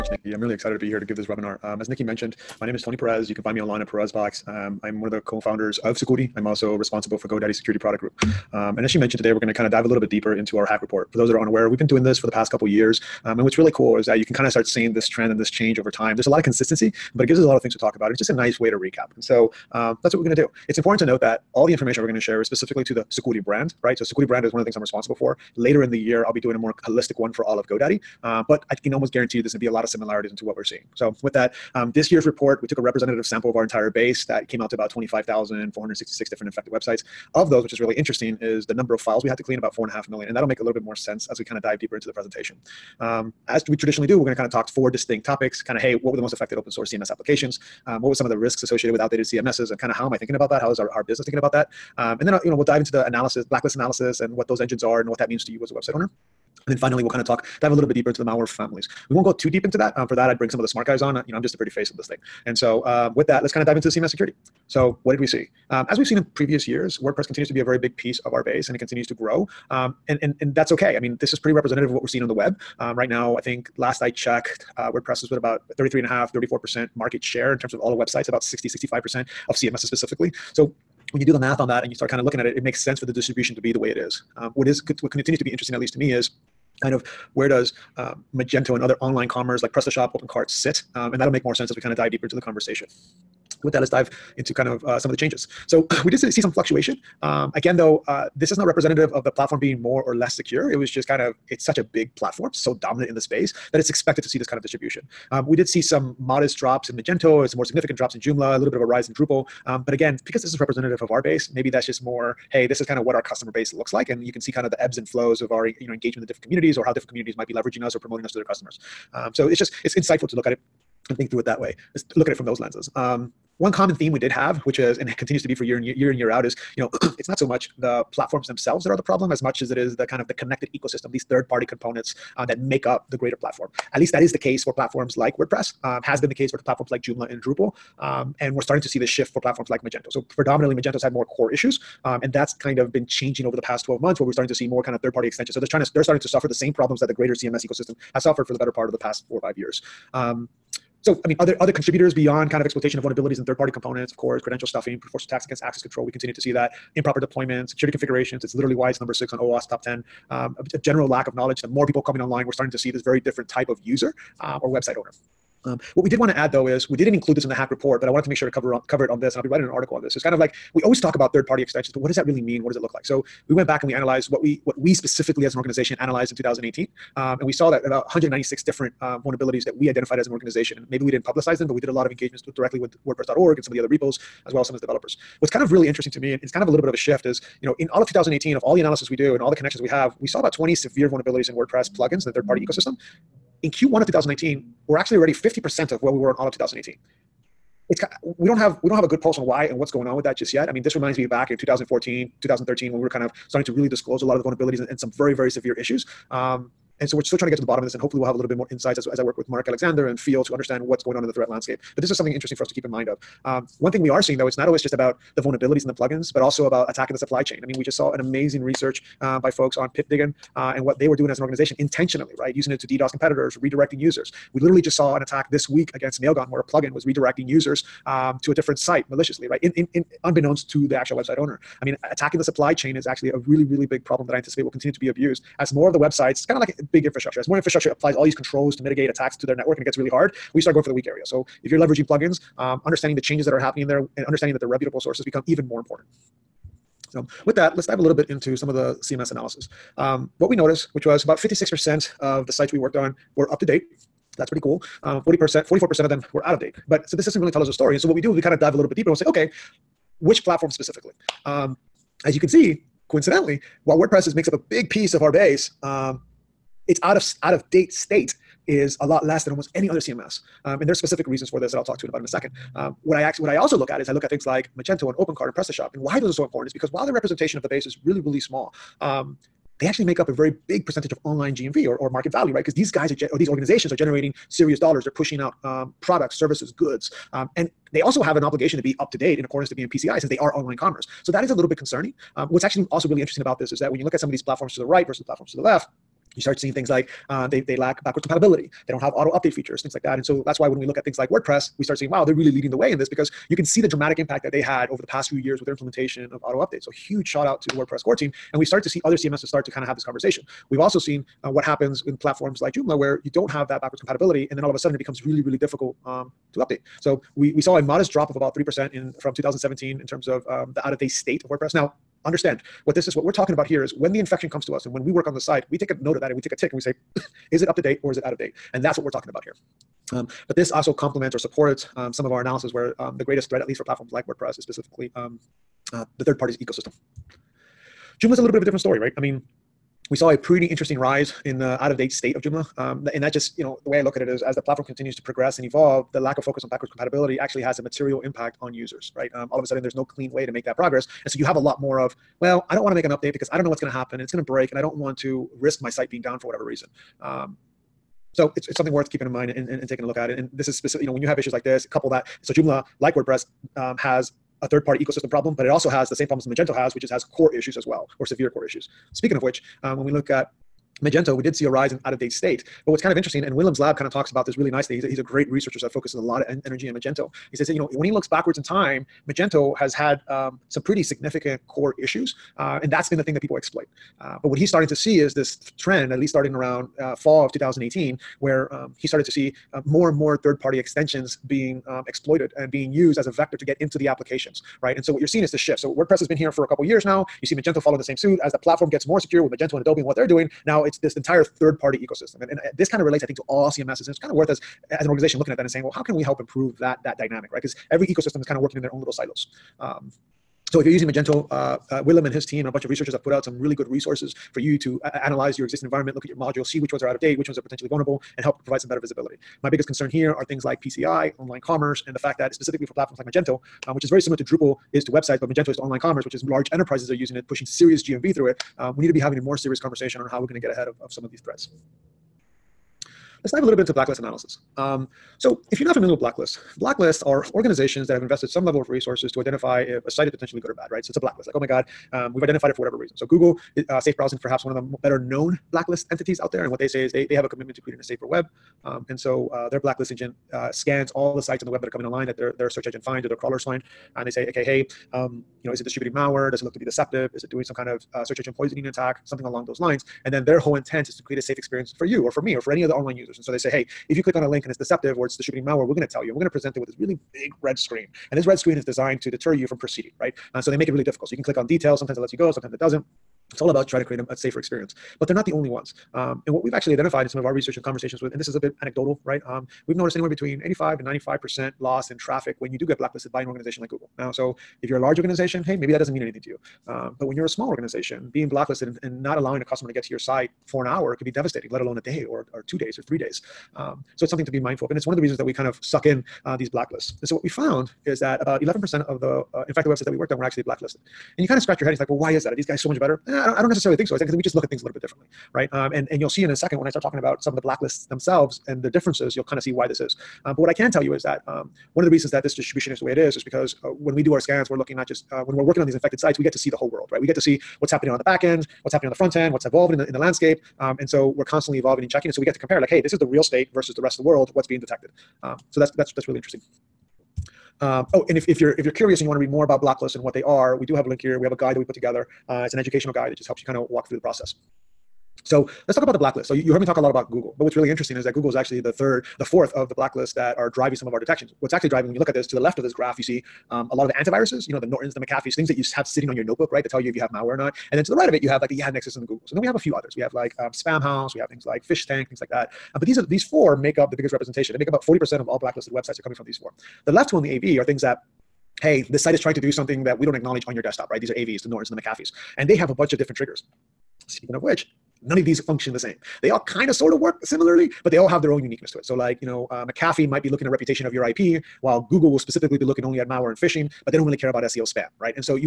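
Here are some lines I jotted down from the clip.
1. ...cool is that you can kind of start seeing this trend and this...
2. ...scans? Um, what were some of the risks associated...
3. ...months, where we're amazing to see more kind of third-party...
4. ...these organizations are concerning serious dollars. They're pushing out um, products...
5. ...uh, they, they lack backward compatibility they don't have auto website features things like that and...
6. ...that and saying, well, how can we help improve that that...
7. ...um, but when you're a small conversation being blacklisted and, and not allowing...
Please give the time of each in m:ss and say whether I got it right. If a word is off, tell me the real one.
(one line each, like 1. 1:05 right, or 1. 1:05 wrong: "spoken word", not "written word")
1. 0:13 right
2. 0:47 wrong: "applications", not "scans"
3. 2:23 wrong: "starting", not "amazing"
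4. 4:43 wrong: "generating", not "concerning"
5. 4:57 wrong: "update", not "website"
6. 6:45 right
7. 8:06 wrong: "organization", not "conversation".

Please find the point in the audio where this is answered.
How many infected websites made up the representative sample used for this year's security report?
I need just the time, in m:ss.
0:34.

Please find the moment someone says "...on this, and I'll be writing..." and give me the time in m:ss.
2:49.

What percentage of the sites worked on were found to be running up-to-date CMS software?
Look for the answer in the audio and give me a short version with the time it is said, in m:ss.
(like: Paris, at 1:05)
56%, at 4:11.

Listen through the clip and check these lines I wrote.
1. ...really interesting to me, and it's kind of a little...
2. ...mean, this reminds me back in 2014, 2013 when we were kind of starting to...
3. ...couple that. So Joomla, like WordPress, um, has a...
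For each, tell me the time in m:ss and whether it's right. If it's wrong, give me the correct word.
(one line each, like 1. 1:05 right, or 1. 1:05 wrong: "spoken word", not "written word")
1. 3:05 right
2. 3:20 right
3. 6:01 right.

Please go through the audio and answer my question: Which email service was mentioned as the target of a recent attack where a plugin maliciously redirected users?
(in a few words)
Mailgun.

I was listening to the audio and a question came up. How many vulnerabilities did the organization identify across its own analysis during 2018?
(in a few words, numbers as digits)
196.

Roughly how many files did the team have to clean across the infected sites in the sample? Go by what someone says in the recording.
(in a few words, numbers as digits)
about 4.5 million.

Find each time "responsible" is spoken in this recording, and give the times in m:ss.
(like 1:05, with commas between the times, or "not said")
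0:06, 0:24.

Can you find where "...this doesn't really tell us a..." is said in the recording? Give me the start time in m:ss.
4:17.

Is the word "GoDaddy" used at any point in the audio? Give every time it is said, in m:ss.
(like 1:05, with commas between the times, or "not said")
0:07, 0:27.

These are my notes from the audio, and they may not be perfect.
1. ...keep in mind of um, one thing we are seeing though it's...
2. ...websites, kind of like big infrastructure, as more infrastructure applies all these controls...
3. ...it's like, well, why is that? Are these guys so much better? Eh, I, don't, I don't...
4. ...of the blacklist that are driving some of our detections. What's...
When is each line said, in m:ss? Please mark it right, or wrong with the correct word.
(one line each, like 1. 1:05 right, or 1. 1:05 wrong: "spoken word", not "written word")
1. 3:32 right
2. 3:55 right
3. 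8:21 right
4. 8:59 right.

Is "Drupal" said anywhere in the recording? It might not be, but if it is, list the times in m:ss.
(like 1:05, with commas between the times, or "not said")
1:49, 2:17, 7:04.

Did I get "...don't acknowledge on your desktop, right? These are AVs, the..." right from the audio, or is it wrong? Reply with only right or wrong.
right.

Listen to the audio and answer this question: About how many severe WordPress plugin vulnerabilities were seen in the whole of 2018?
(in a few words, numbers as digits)
about 20.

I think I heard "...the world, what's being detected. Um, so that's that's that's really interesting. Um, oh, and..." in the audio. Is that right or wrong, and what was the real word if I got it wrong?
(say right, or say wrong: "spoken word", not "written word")
right.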